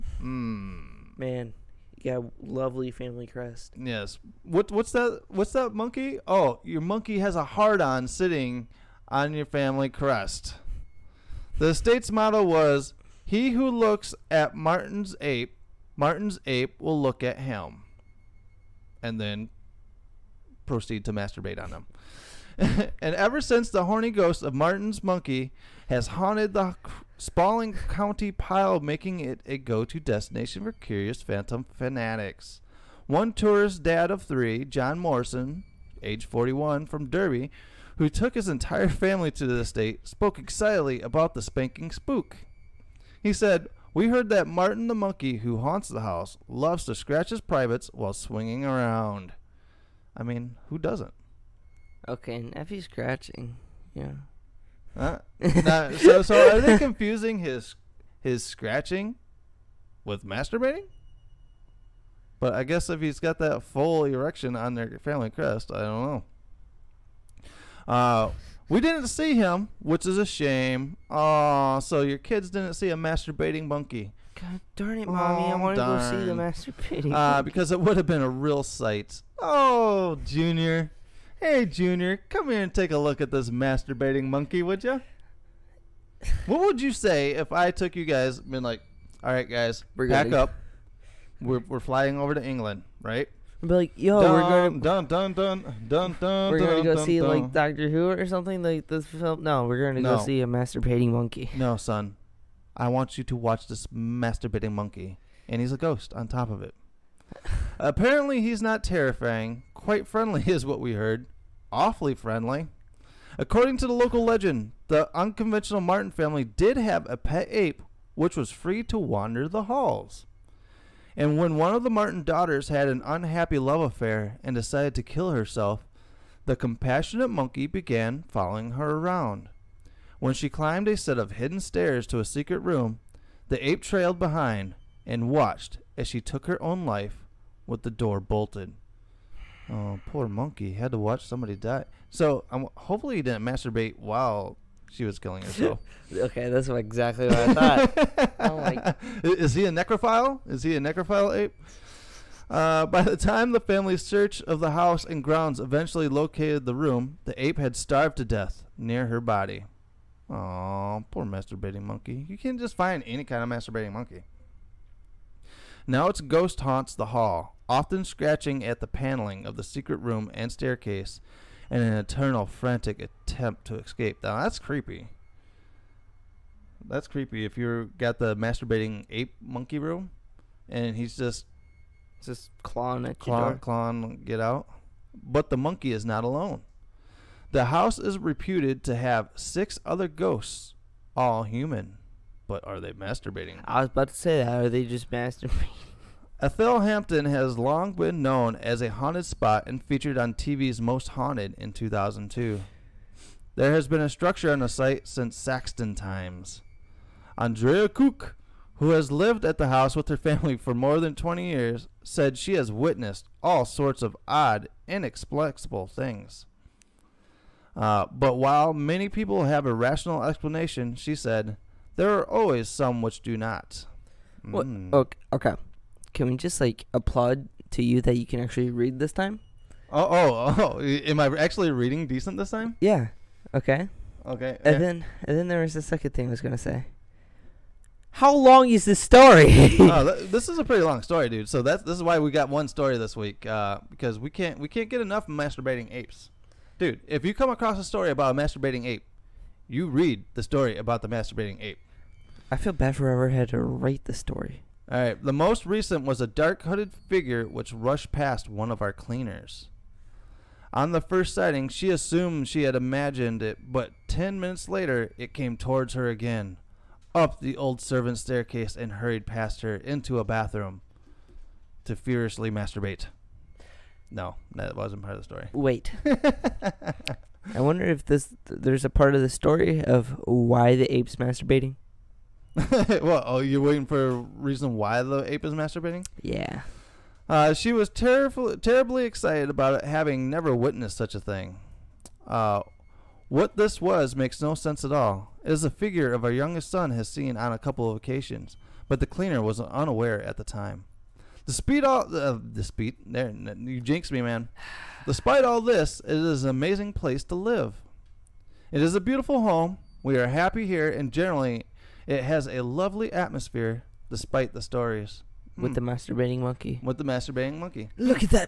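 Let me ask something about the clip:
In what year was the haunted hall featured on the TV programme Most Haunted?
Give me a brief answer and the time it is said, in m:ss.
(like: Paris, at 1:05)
2002, at 3:21.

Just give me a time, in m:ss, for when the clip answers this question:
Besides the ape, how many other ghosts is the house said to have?
3:09.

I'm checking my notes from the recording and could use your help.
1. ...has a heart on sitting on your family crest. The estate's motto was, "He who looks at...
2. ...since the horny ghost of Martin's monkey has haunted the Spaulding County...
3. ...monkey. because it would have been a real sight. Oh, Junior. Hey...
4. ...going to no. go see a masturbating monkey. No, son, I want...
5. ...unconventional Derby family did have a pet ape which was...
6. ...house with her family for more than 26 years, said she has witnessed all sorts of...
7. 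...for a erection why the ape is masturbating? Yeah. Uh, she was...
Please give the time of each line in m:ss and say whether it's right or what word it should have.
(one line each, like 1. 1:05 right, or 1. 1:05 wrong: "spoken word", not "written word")
1. 0:07 right
2. 0:23 right
3. 1:17 right
4. 1:39 right
5. 1:55 wrong: "Martin", not "Derby"
6. 3:29 wrong: "20", not "26"
7. 4:43 wrong: "reason", not "erection".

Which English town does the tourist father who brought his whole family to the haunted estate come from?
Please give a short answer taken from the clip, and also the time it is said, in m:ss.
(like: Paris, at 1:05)
Derby, at 0:37.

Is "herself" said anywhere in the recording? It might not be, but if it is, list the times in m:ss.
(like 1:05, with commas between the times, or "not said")
2:05, 2:25.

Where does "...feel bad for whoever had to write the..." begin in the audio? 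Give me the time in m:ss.
4:12.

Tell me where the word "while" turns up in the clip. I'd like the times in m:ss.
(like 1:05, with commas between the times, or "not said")
0:47, 2:23, 3:38.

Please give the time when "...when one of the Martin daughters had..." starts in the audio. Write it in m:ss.
2:01.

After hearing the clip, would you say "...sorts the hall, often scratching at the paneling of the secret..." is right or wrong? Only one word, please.
wrong.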